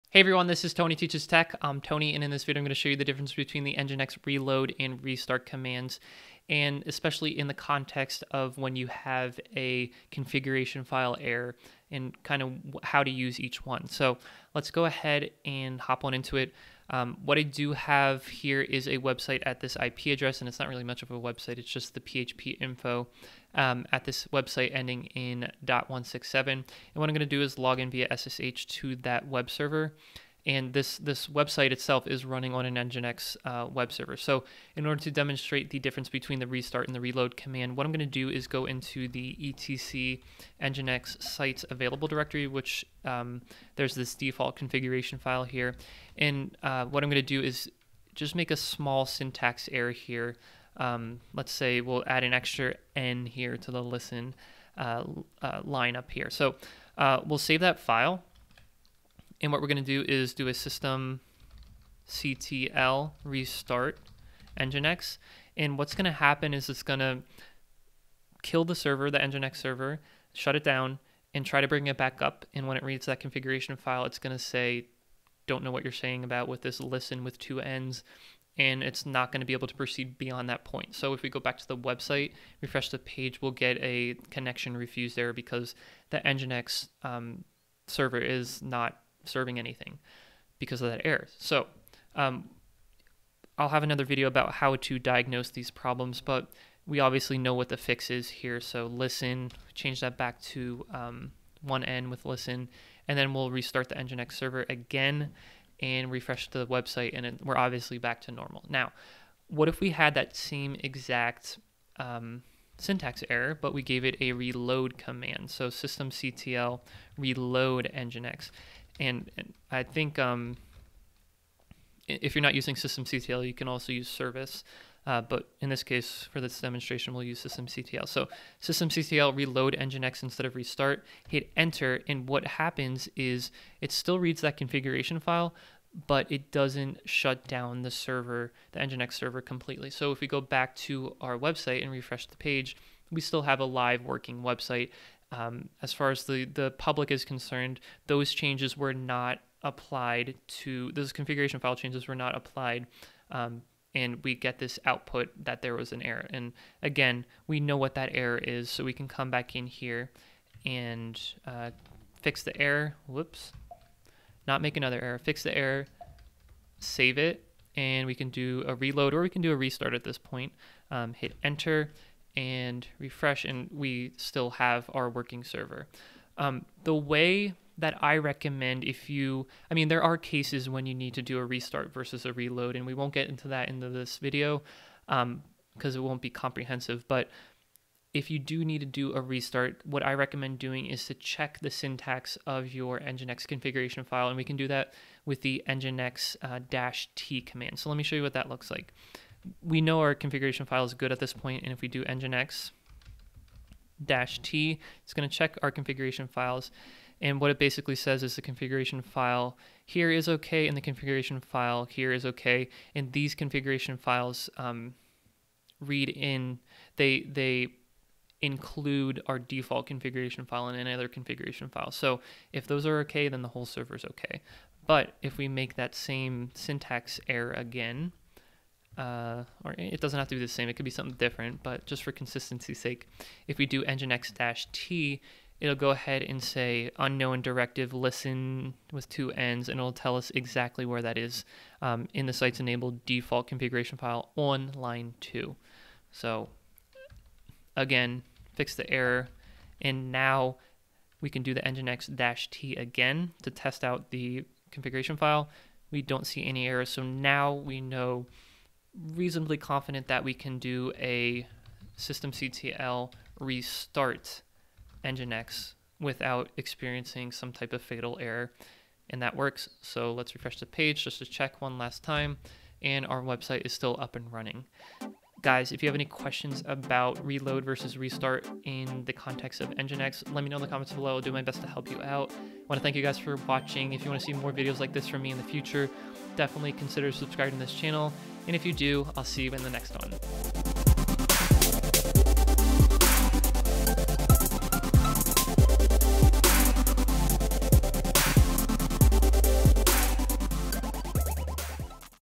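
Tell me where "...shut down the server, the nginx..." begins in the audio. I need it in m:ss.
2:17.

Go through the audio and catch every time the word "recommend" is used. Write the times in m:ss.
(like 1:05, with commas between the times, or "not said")
2:58, 3:10.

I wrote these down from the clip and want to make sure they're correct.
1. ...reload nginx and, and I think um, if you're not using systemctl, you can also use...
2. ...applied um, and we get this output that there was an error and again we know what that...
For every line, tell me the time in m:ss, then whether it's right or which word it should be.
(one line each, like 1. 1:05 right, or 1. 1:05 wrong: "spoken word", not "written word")
1. 1:57 right
2. 2:32 right.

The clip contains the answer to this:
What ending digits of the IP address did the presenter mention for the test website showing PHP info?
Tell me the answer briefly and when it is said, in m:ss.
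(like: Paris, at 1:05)
167, at 0:25.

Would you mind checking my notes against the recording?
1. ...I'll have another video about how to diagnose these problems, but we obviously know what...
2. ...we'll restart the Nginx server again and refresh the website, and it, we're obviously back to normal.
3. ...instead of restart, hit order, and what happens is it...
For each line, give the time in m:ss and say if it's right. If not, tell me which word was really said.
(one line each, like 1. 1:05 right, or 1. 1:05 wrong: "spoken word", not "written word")
1. 1:33 right
2. 1:43 right
3. 2:10 wrong: "enter", not "order".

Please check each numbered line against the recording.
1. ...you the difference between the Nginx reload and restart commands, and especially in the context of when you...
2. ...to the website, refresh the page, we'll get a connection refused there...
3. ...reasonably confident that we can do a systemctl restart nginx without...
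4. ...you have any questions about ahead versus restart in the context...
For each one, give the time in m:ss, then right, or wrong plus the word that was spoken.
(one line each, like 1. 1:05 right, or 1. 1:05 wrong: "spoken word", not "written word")
1. 0:02 right
2. 1:21 right
3. 4:19 right
4. 4:35 wrong: "reload", not "ahead".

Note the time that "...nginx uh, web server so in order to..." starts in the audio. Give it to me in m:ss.
0:32.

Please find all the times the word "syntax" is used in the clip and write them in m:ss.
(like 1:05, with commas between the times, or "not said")
0:49, 1:52, 3:11, 3:46.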